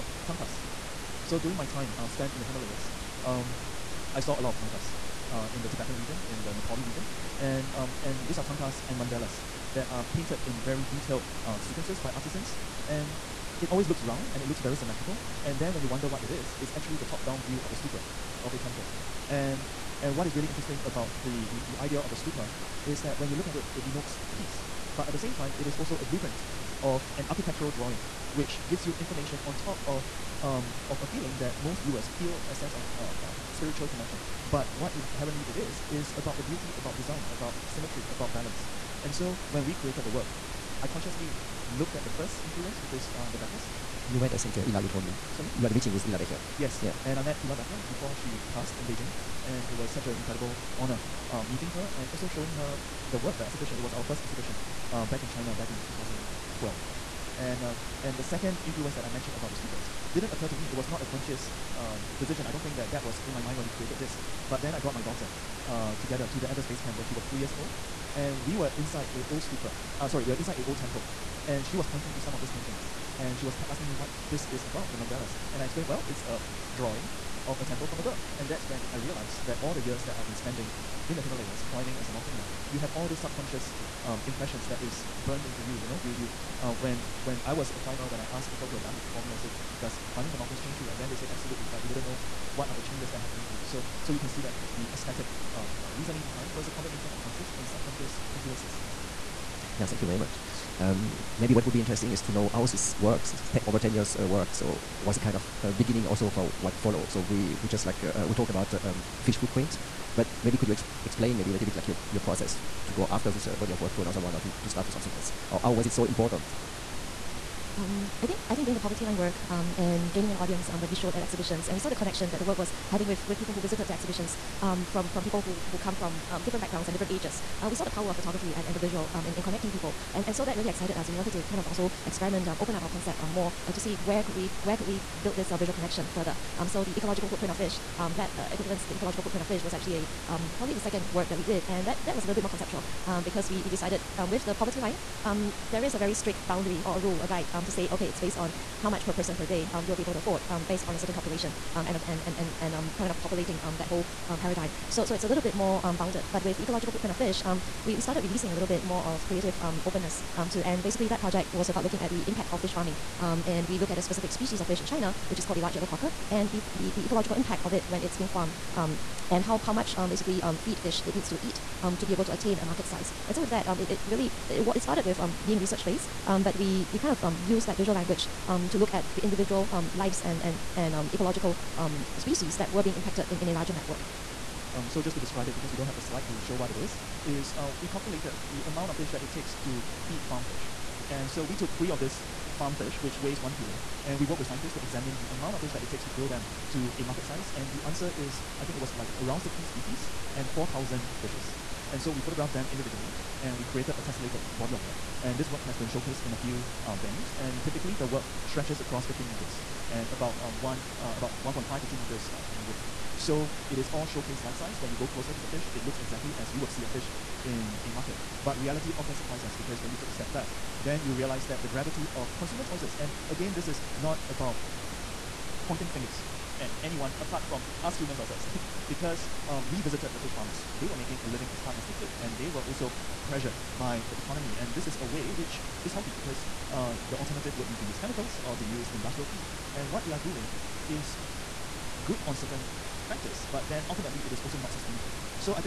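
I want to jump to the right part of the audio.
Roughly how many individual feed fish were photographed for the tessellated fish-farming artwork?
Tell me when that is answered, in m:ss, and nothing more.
3:20.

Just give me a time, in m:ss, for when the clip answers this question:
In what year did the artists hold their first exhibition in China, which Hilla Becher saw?
0:55.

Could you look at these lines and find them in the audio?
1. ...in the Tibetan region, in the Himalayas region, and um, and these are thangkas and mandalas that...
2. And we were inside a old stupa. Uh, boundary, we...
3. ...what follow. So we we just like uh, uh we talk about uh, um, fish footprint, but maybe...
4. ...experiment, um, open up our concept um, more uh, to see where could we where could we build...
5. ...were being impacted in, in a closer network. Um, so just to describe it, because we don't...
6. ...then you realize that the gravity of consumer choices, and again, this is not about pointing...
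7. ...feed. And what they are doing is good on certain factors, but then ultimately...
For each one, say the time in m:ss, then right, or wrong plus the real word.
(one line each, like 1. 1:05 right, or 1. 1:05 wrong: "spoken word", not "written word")
1. 0:05 wrong: "Nepali", not "Himalayas"
2. 1:08 wrong: "sorry", not "boundary"
3. 1:46 right
4. 2:12 right
5. 3:02 wrong: "larger", not "closer"
6. 3:40 right
7. 3:59 right.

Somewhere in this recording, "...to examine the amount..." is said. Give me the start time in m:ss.
3:14.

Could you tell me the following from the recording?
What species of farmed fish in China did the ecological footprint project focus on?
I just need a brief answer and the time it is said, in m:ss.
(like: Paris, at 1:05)
Large yellow croaker, at 2:45.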